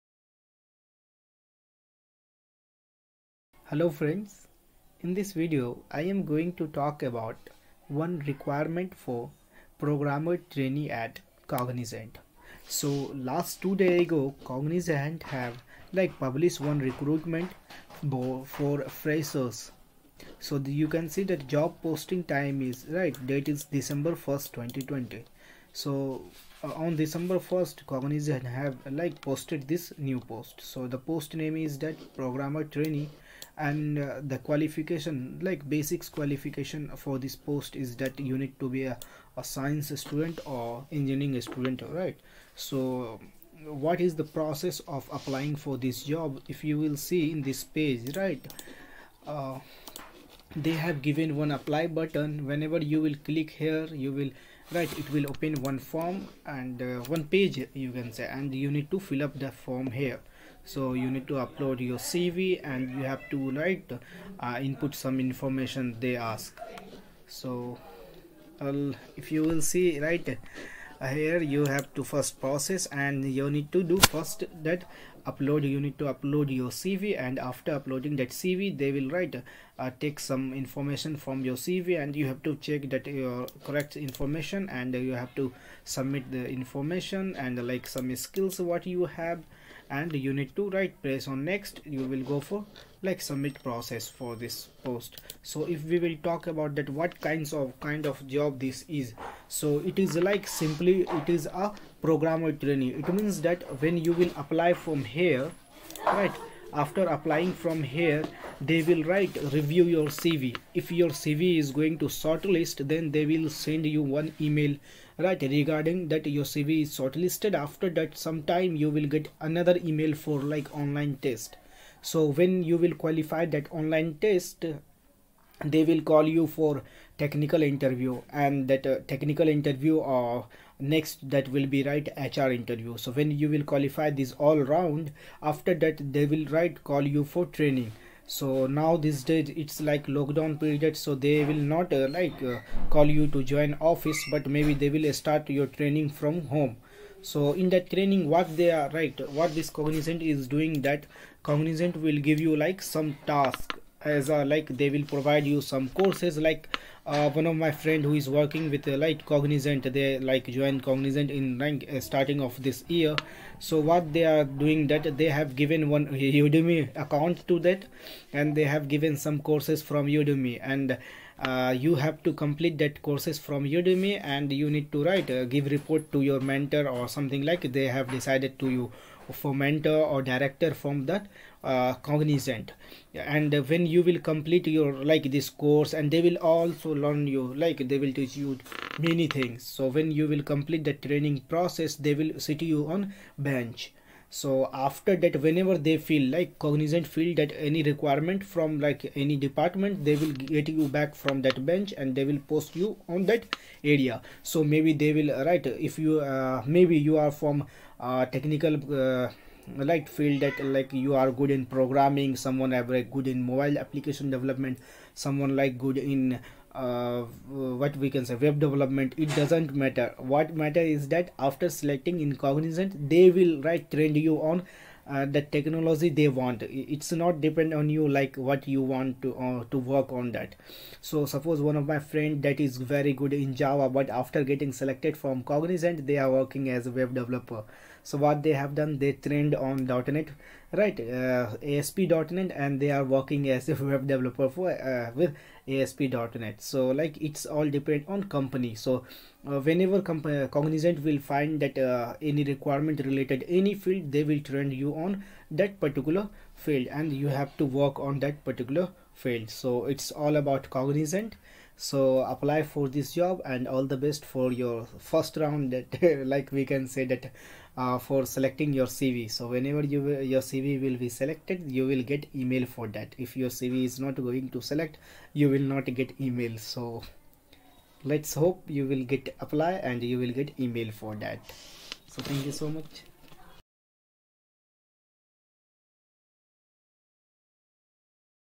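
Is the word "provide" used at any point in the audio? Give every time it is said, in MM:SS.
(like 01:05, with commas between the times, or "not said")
02:35.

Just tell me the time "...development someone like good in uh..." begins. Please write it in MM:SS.
03:34.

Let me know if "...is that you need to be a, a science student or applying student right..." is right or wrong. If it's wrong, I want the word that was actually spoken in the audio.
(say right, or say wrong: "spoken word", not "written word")
wrong: "engineering", not "applying".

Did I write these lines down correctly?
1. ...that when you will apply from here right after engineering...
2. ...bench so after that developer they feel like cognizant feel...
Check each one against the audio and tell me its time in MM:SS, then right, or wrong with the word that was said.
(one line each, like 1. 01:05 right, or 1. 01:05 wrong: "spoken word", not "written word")
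1. 01:43 wrong: "applying", not "engineering"
2. 03:13 wrong: "whenever", not "developer".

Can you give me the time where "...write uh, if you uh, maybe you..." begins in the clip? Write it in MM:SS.
03:25.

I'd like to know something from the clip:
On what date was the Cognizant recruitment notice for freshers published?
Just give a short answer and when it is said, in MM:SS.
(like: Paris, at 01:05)
December 1st 2020, at 00:23.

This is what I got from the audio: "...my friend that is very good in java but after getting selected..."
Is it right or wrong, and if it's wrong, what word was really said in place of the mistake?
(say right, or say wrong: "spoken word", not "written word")
right.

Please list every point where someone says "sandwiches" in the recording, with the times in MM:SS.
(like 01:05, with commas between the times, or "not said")
not said.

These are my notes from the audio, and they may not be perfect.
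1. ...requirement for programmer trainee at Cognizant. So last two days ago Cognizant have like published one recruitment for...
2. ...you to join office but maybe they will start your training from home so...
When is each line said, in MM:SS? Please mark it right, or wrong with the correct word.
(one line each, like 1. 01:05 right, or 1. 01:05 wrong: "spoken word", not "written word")
1. 00:08 right
2. 02:23 right.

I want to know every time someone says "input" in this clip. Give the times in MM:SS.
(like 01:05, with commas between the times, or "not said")
01:04.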